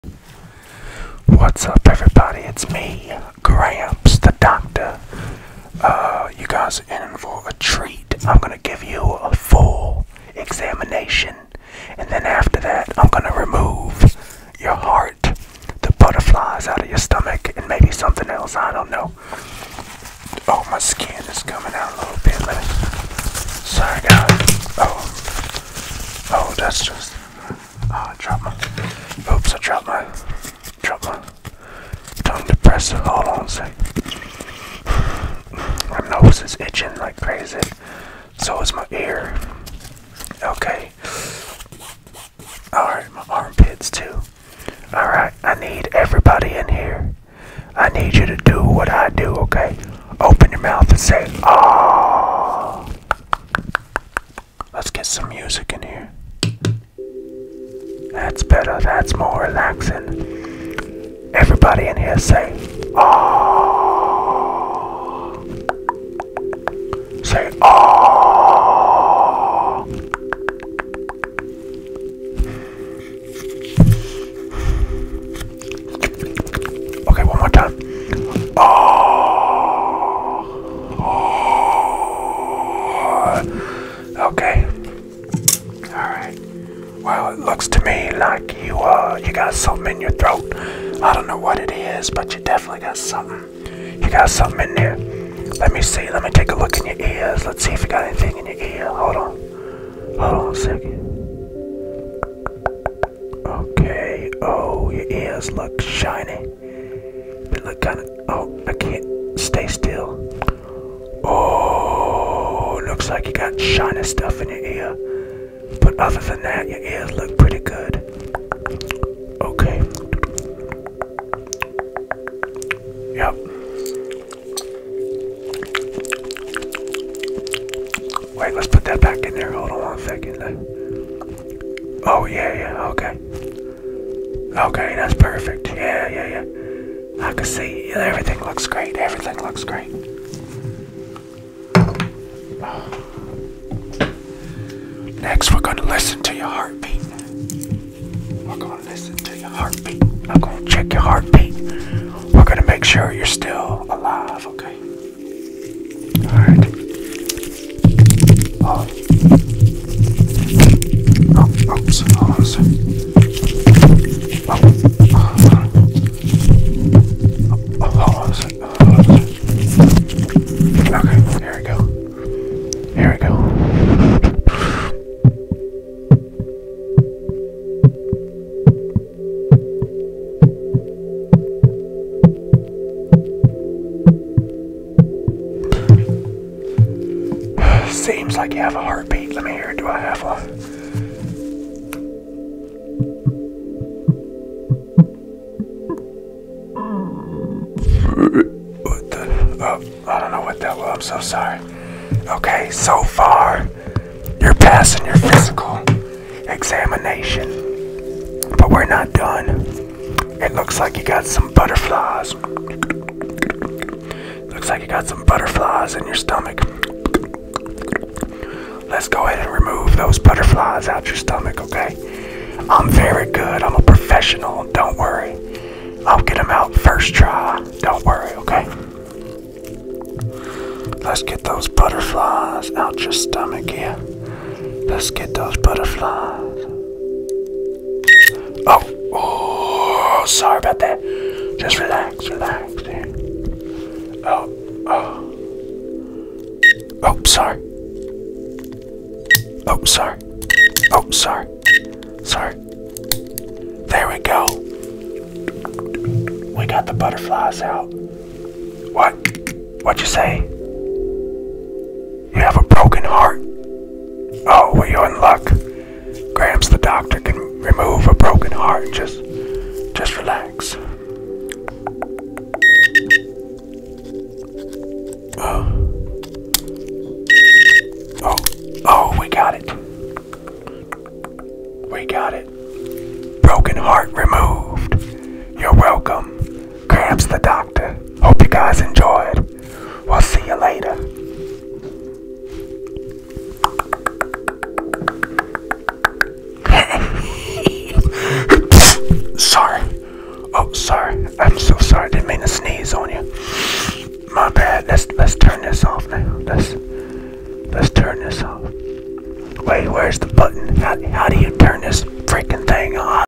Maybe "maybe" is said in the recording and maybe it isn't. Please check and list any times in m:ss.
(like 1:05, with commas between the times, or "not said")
0:17.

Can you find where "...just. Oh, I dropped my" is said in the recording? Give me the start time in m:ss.
0:26.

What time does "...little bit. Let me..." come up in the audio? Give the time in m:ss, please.
0:21.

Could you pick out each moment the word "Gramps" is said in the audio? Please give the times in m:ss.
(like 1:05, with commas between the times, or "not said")
0:03, 4:26, 4:46.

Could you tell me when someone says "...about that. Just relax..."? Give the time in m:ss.
4:00.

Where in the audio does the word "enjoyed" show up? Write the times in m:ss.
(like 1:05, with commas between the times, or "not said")
4:48.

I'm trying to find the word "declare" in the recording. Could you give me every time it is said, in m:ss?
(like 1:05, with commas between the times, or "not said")
not said.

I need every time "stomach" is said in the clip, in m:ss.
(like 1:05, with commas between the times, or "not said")
0:16, 3:36, 3:41, 3:53.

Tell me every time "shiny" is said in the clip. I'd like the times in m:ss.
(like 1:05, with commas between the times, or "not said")
1:45, 1:53.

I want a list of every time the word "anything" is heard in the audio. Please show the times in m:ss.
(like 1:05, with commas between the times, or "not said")
1:38.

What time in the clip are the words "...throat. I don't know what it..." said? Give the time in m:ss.
1:30.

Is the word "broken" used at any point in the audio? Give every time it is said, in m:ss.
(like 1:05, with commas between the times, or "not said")
4:22, 4:28, 4:43.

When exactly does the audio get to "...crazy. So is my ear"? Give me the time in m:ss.
0:37.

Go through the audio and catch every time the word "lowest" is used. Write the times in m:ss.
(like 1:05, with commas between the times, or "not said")
not said.